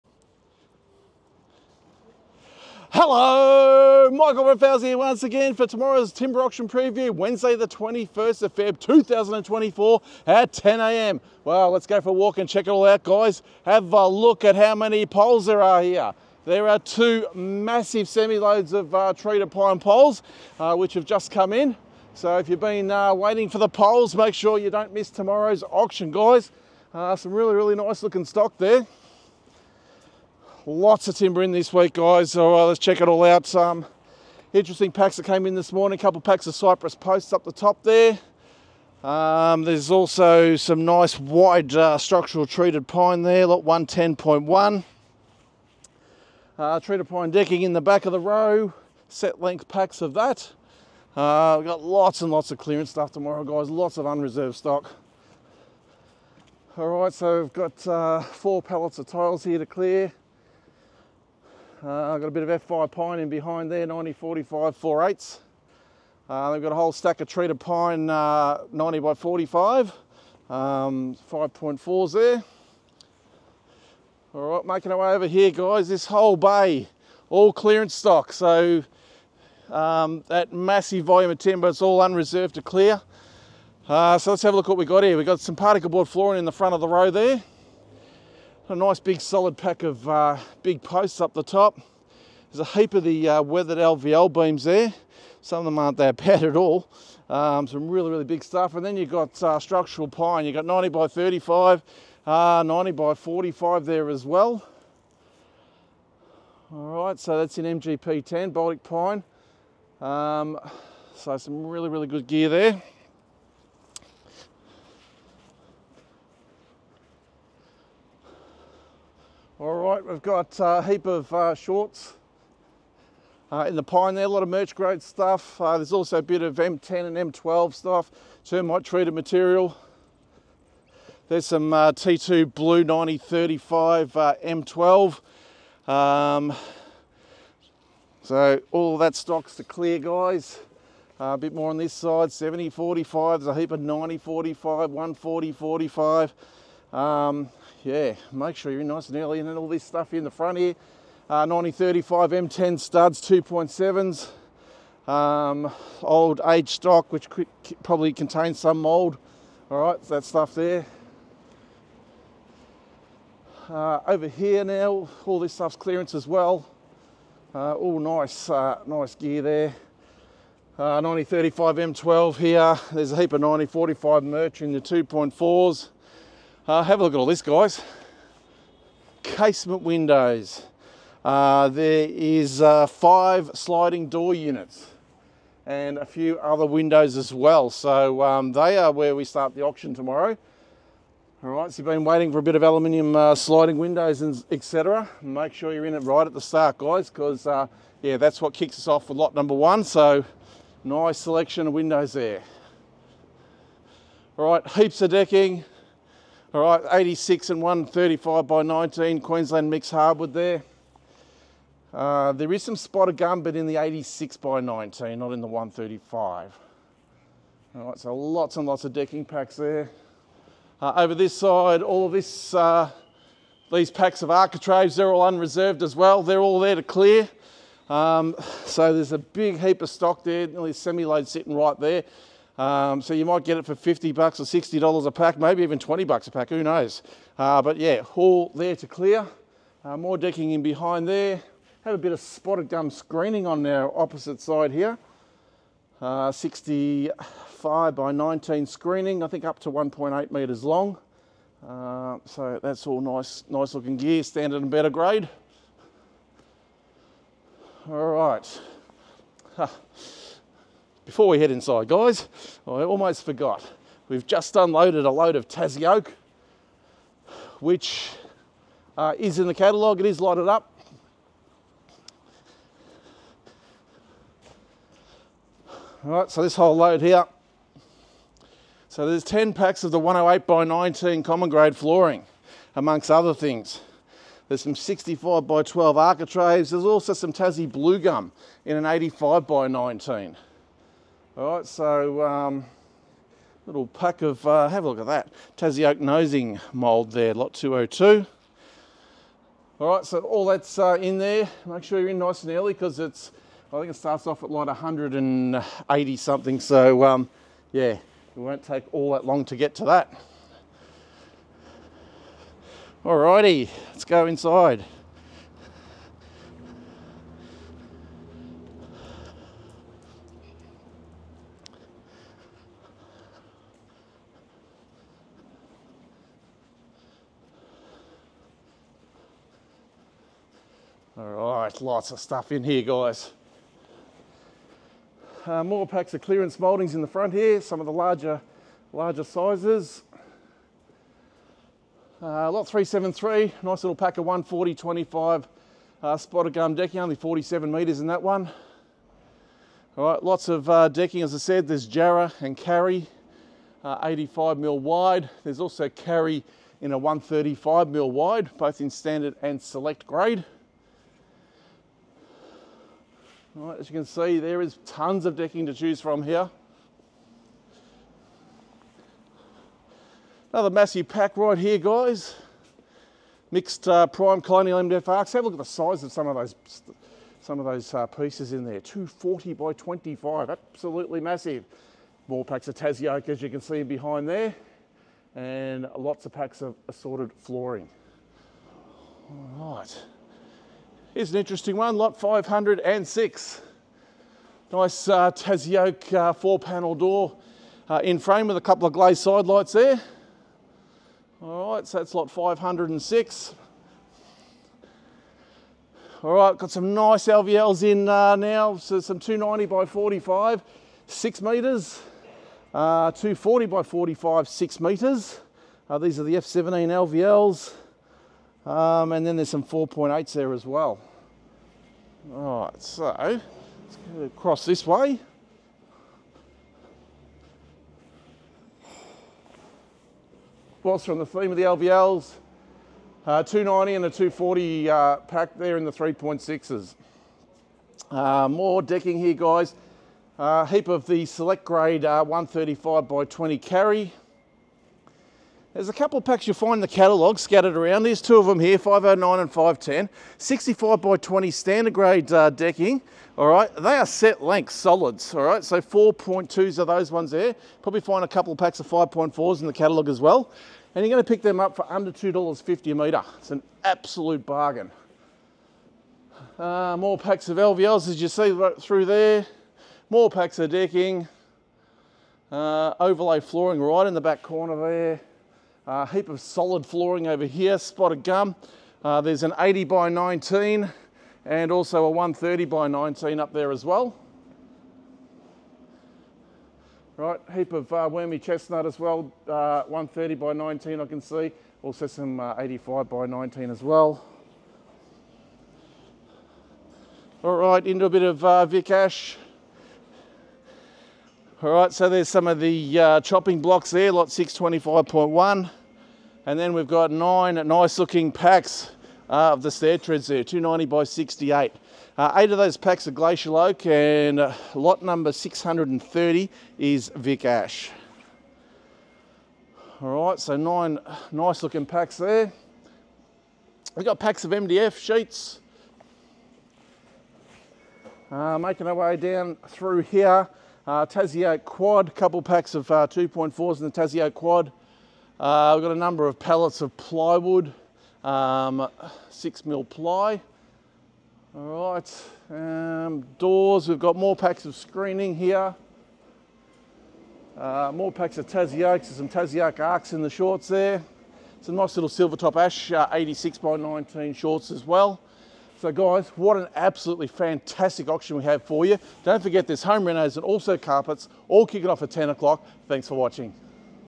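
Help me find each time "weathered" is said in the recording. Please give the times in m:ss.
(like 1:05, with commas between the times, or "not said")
1:33.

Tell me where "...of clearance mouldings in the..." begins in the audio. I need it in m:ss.
5:36.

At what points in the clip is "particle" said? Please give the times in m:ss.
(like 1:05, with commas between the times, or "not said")
1:25.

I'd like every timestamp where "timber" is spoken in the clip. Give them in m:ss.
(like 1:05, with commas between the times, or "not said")
0:06, 0:31, 1:21.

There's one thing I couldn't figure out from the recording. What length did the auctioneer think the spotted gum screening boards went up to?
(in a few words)
1.8 metres.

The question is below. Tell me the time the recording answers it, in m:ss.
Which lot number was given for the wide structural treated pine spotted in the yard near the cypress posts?
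0:43.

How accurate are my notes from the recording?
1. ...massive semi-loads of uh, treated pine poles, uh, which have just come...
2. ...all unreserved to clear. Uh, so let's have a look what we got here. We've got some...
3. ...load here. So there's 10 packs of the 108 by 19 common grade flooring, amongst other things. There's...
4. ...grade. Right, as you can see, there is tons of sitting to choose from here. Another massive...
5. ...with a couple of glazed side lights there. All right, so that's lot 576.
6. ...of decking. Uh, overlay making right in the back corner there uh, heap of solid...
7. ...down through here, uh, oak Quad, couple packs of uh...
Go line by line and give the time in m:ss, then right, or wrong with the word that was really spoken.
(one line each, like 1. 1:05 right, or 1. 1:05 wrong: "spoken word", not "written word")
1. 0:17 right
2. 1:21 right
3. 4:36 right
4. 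6:00 wrong: "decking", not "sitting"
5. 6:38 wrong: "506", not "576"
6. 7:50 wrong: "flooring", not "making"
7. 8:49 right.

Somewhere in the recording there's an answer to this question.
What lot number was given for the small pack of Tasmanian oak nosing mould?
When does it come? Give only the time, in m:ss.
4:57.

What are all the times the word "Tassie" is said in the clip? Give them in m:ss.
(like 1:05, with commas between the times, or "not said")
4:25, 4:47, 4:55, 6:22, 9:08.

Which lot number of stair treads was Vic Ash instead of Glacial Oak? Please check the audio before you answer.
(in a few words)
630.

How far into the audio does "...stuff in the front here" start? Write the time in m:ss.
2:29.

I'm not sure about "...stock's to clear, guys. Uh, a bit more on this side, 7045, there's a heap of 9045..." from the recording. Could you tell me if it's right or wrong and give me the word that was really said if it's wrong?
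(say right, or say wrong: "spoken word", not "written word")
right.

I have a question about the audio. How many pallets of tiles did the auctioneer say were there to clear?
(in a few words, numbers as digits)
4.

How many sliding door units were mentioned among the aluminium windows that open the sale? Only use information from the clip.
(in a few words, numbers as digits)
5.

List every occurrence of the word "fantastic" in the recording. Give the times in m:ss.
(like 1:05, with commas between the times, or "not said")
9:17.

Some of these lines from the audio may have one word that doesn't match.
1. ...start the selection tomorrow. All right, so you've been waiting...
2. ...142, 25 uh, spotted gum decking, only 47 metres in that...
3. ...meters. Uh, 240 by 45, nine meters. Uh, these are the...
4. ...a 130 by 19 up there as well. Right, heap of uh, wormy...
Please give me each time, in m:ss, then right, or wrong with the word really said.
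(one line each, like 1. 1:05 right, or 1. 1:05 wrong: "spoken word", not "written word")
1. 3:09 wrong: "auction", not "selection"
2. 5:44 wrong: "140", not "142"
3. 6:51 wrong: "six", not "nine"
4. 8:02 right.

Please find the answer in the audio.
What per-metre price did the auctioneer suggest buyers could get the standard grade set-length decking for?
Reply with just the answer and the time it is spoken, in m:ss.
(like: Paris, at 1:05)
under $2.50, at 7:41.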